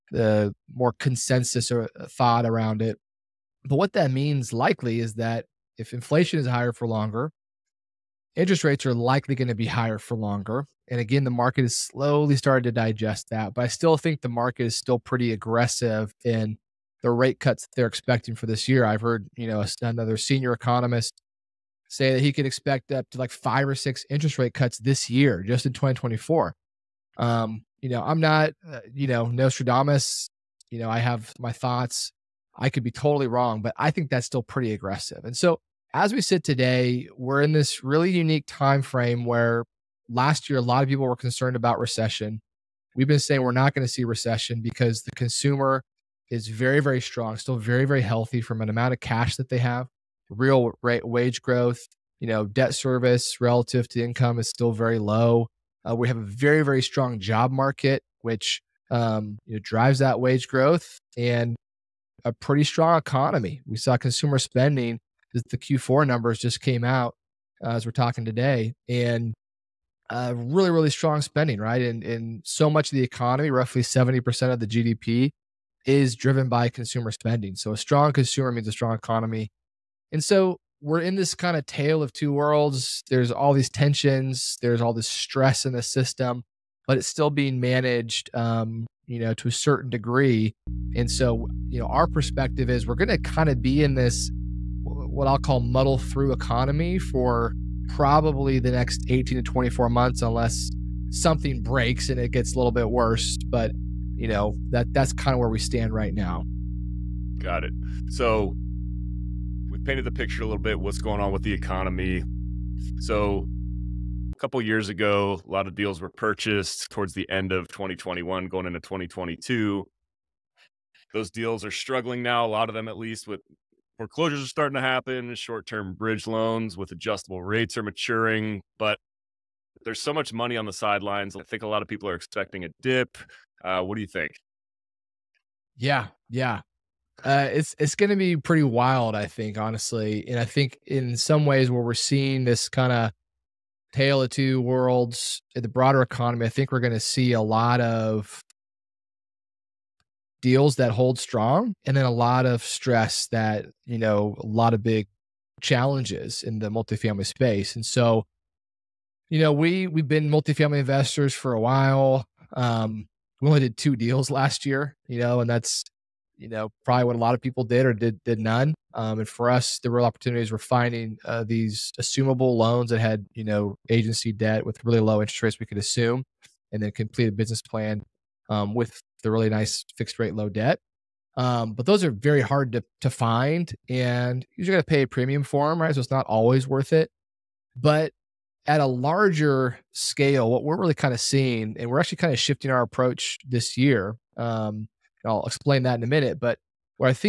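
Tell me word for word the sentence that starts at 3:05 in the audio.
So it's not always worth it.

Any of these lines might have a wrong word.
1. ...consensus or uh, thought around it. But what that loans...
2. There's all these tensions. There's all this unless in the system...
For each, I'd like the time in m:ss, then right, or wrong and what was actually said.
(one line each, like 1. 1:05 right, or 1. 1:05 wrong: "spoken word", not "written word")
1. 0:00 wrong: "means", not "loans"
2. 1:23 wrong: "stress", not "unless".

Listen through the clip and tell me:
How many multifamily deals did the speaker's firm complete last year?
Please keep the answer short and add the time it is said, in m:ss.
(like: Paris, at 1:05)
2, at 2:43.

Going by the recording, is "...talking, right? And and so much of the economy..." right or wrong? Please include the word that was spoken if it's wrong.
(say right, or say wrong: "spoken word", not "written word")
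wrong: "spending", not "talking".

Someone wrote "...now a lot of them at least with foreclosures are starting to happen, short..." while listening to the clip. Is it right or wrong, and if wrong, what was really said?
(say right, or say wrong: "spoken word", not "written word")
right.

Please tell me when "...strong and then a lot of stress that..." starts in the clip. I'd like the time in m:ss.
2:31.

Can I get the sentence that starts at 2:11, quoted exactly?
I think a lot of people are expecting a dip.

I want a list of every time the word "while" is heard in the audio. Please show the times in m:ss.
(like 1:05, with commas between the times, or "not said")
2:41.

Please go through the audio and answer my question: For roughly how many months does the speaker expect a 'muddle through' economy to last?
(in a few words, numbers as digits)
18 to 24 months.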